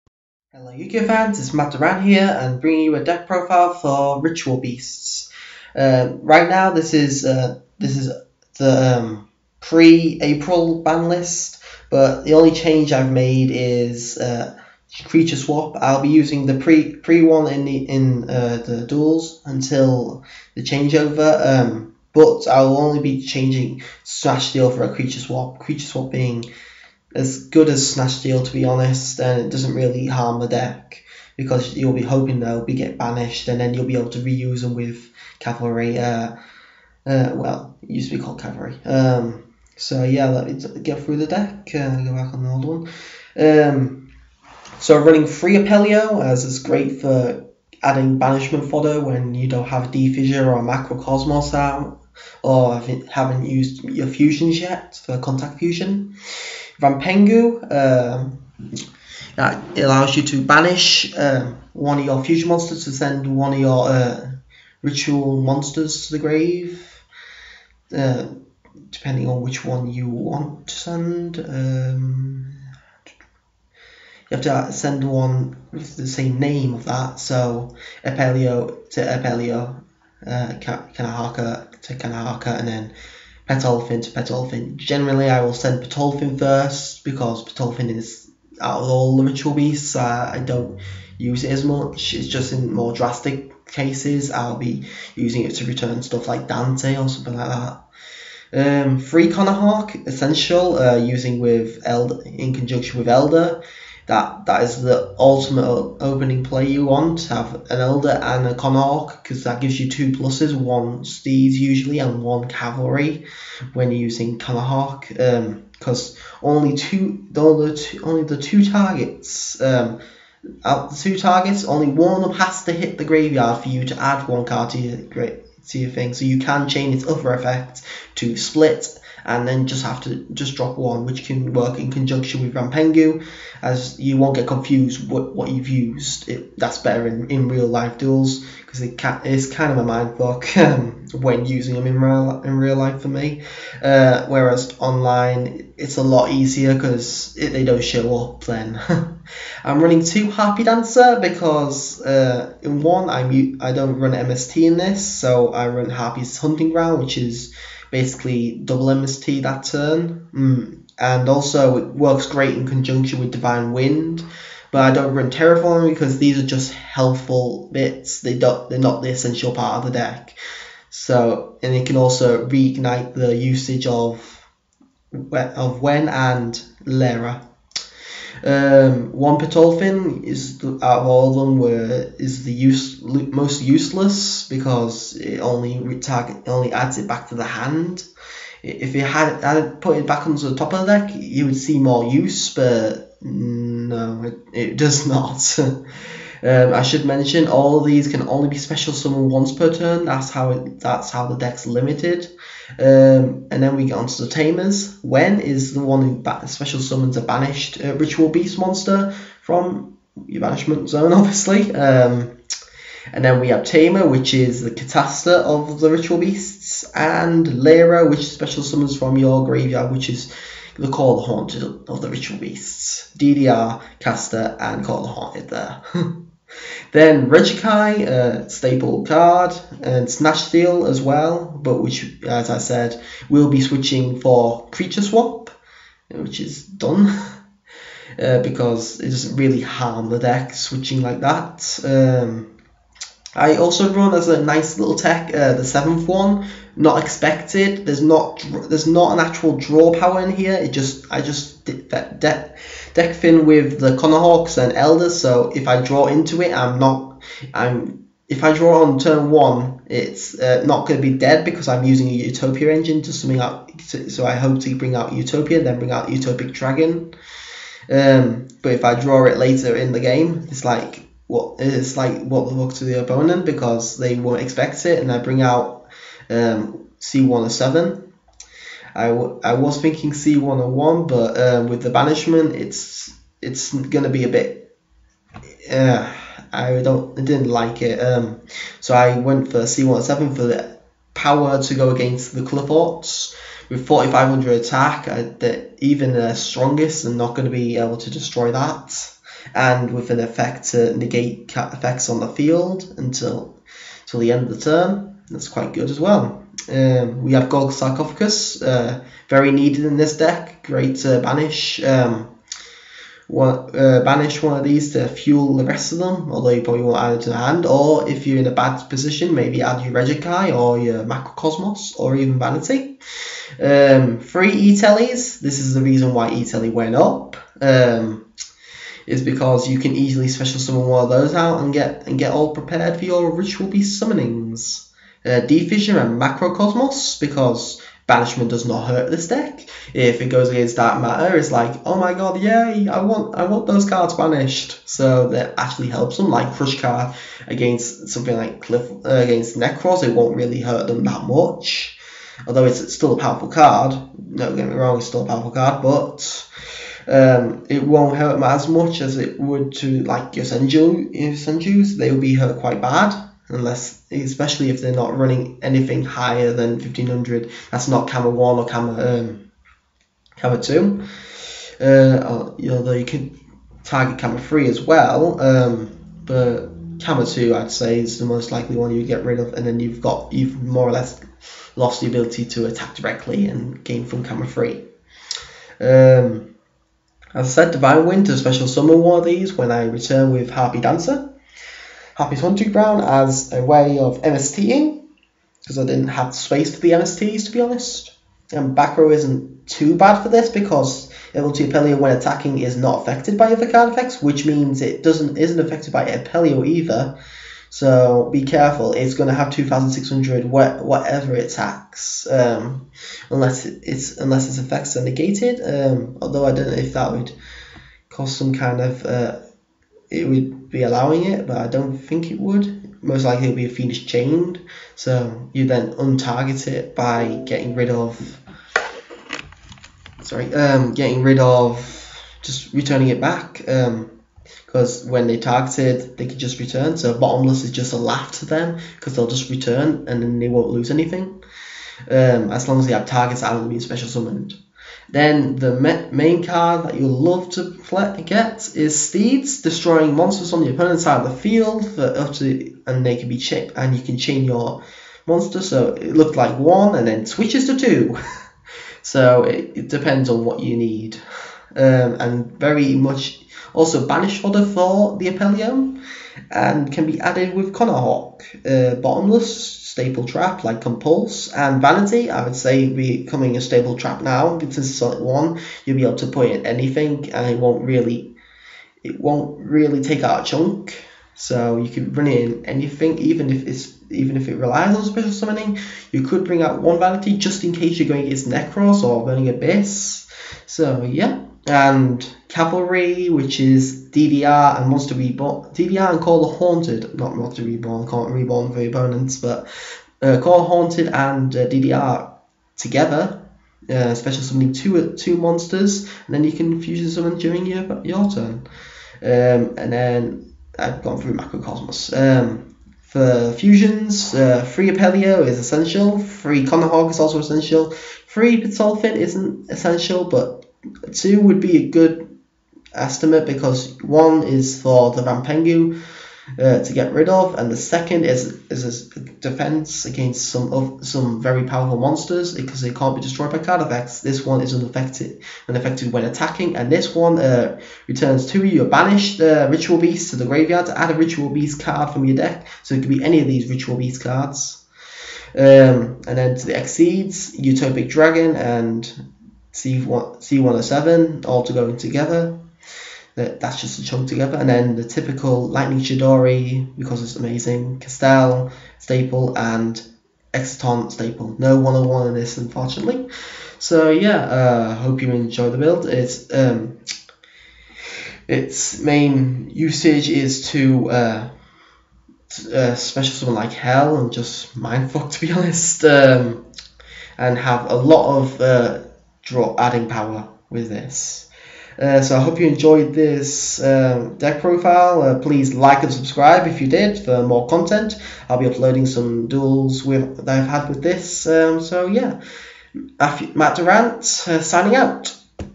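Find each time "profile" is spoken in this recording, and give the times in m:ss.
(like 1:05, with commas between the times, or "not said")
0:03, 9:44.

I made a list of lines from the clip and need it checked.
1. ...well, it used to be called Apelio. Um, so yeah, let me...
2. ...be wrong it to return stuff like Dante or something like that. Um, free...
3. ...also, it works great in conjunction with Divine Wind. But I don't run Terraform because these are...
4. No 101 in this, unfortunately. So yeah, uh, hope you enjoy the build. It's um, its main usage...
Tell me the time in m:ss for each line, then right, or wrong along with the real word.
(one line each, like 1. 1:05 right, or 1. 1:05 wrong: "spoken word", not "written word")
1. 0:37 wrong: "Cavalry", not "Apelio"
2. 1:34 wrong: "using", not "wrong"
3. 2:41 right
4. 9:21 right.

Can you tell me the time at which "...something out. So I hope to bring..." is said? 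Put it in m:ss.
4:23.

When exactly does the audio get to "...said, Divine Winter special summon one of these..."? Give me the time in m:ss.
6:27.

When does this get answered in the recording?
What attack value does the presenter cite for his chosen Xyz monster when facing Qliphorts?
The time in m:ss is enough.
4:53.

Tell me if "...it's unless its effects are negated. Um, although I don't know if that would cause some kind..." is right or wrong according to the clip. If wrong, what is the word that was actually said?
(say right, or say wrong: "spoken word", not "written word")
right.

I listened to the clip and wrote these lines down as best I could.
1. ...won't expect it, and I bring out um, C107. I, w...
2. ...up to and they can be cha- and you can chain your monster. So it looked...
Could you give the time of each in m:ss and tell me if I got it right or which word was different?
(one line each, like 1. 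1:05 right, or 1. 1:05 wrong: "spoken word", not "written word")
1. 4:34 right
2. 7:32 right.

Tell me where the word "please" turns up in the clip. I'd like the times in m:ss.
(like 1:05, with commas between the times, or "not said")
9:45.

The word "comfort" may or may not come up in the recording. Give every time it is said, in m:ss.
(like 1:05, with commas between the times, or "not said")
not said.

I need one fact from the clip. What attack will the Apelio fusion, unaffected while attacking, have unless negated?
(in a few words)
2600.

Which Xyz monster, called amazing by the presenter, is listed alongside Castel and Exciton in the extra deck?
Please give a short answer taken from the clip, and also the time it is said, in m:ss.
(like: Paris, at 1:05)
Lightning Chidori, at 9:15.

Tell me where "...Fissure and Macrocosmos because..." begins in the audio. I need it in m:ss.
5:35.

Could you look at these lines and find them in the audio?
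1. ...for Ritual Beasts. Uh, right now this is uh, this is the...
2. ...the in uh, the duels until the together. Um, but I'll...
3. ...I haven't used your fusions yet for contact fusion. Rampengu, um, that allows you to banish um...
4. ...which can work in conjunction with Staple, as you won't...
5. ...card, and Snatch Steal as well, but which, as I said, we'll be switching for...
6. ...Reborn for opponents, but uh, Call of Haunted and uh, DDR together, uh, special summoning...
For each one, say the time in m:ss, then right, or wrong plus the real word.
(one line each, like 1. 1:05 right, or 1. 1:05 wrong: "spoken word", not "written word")
1. 0:03 right
2. 0:17 wrong: "changeover", not "together"
3. 0:52 right
4. 2:11 wrong: "Rampengu", not "Staple"
5. 3:49 right
6. 8:18 right.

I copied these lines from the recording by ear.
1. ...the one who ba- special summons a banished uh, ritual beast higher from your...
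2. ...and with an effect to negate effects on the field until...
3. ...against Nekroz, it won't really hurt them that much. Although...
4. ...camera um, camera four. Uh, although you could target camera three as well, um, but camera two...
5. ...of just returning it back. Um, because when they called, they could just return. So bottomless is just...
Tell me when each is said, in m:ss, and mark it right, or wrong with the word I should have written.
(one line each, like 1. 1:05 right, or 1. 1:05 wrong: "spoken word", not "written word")
1. 3:25 wrong: "monster", not "higher"
2. 4:59 right
3. 5:49 right
4. 6:08 wrong: "two", not "four"
5. 7:11 wrong: "targeted", not "called".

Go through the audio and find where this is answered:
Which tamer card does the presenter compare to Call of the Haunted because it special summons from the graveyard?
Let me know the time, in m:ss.
3:37.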